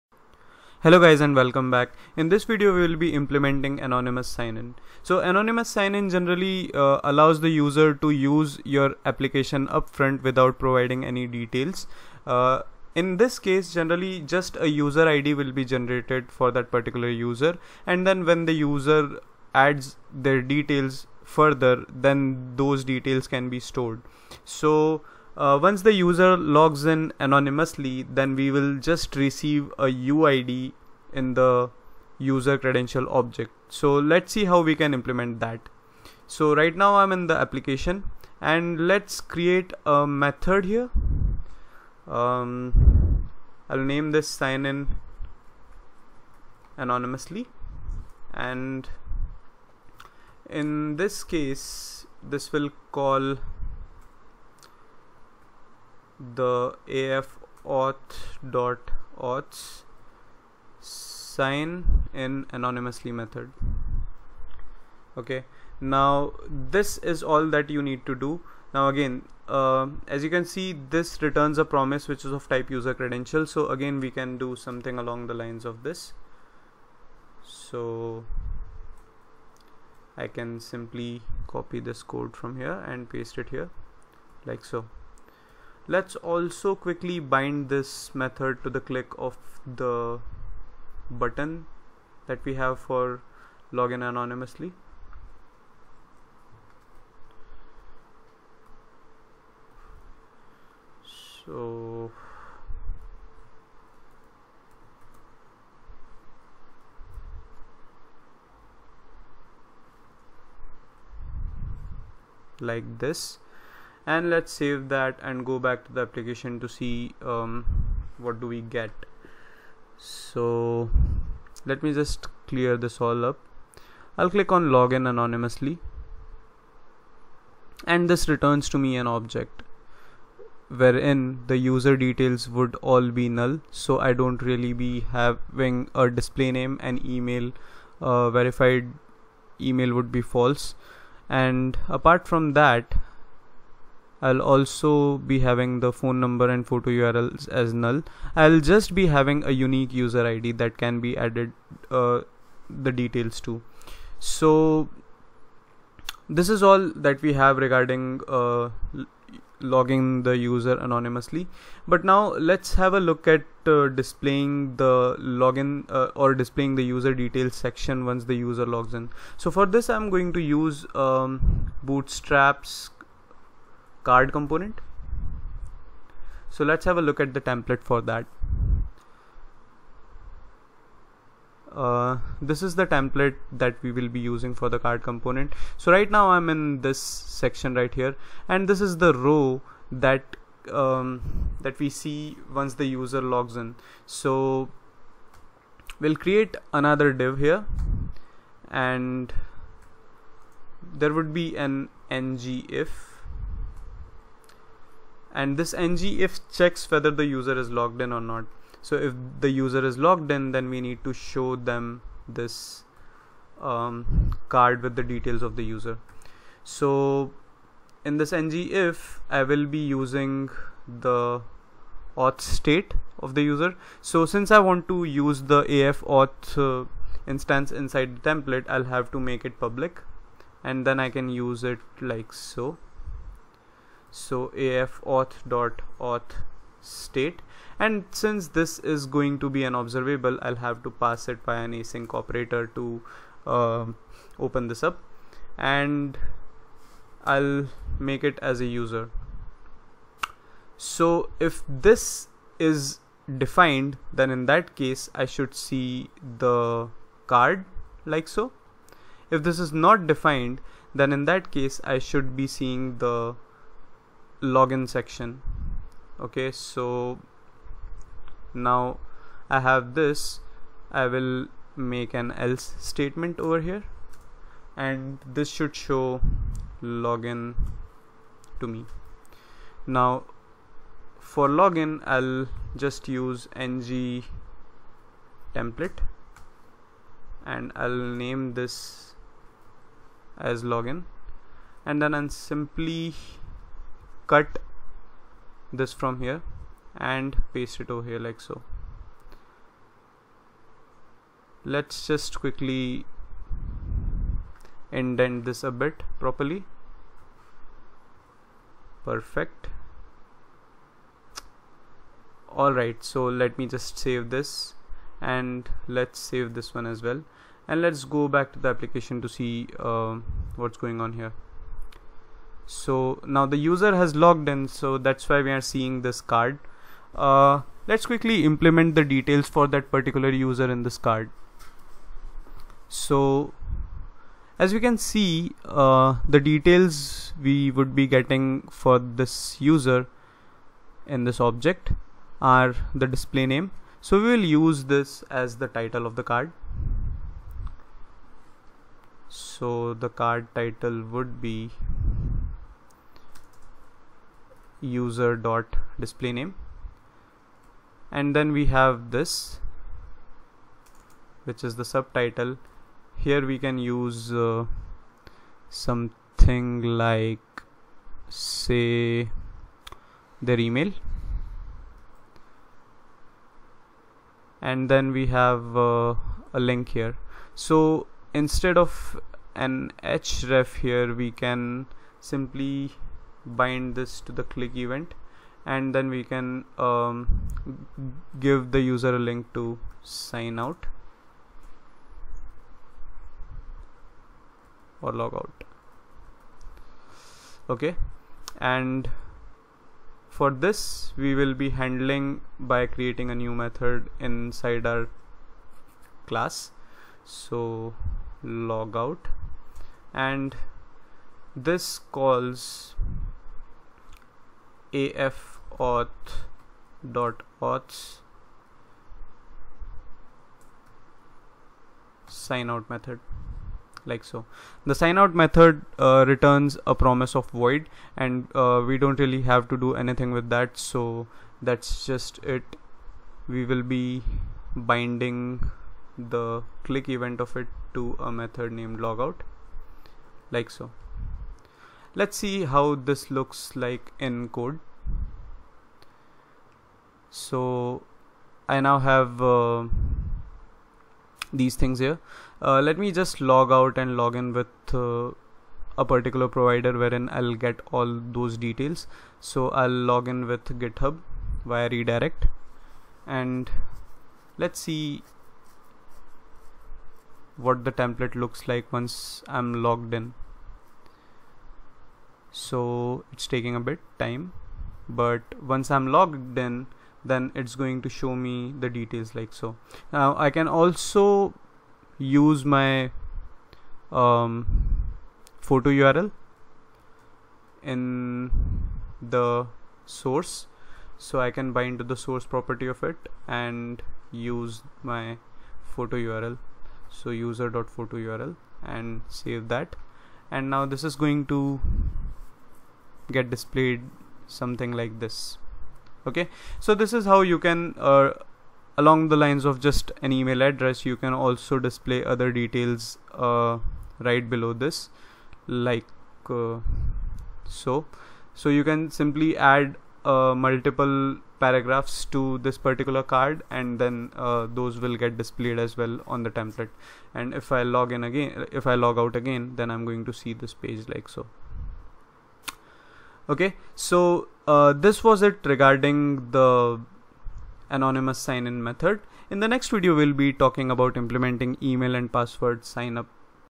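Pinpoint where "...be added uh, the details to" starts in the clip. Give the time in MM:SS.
02:30.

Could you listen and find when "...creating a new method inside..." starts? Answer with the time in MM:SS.
06:42.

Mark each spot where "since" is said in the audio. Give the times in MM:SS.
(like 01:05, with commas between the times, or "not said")
03:44, 03:58.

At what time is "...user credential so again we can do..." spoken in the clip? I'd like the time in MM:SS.
01:12.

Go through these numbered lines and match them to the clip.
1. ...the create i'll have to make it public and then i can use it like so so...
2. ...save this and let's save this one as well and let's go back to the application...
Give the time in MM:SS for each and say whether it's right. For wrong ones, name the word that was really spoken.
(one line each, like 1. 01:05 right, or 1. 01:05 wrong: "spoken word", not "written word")
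1. 03:48 wrong: "template", not "create"
2. 05:14 right.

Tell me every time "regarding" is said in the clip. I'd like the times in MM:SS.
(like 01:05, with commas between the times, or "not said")
02:37, 08:55.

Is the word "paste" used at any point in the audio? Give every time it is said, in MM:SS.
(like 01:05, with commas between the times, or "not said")
01:23, 04:57.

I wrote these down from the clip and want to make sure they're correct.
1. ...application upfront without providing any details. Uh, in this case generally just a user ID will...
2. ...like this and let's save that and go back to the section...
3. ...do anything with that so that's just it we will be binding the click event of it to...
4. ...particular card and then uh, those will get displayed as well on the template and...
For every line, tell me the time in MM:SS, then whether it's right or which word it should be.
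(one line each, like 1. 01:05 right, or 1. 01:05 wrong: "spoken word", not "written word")
1. 00:09 right
2. 01:52 wrong: "application", not "section"
3. 07:09 right
4. 08:42 right.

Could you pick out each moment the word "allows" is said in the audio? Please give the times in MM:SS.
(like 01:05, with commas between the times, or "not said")
00:07.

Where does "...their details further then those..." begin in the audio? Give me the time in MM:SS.
00:20.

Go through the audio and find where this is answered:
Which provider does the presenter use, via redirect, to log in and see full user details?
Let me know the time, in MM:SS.
07:40.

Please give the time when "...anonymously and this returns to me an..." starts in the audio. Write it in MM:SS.
02:05.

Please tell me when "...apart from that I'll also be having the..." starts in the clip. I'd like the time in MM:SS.
02:21.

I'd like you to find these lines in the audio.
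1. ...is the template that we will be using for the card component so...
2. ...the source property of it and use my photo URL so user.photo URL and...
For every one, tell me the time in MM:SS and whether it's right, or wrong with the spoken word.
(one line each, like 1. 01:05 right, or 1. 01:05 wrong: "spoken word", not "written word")
1. 03:02 right
2. 08:12 right.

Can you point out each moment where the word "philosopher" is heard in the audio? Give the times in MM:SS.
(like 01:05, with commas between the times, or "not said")
not said.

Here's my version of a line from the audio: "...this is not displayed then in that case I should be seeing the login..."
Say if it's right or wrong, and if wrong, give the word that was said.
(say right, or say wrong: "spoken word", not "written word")
wrong: "defined", not "displayed".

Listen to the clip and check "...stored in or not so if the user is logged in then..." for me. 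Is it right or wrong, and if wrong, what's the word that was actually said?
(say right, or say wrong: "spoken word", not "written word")
wrong: "logged", not "stored".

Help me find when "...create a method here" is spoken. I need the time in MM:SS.
00:39.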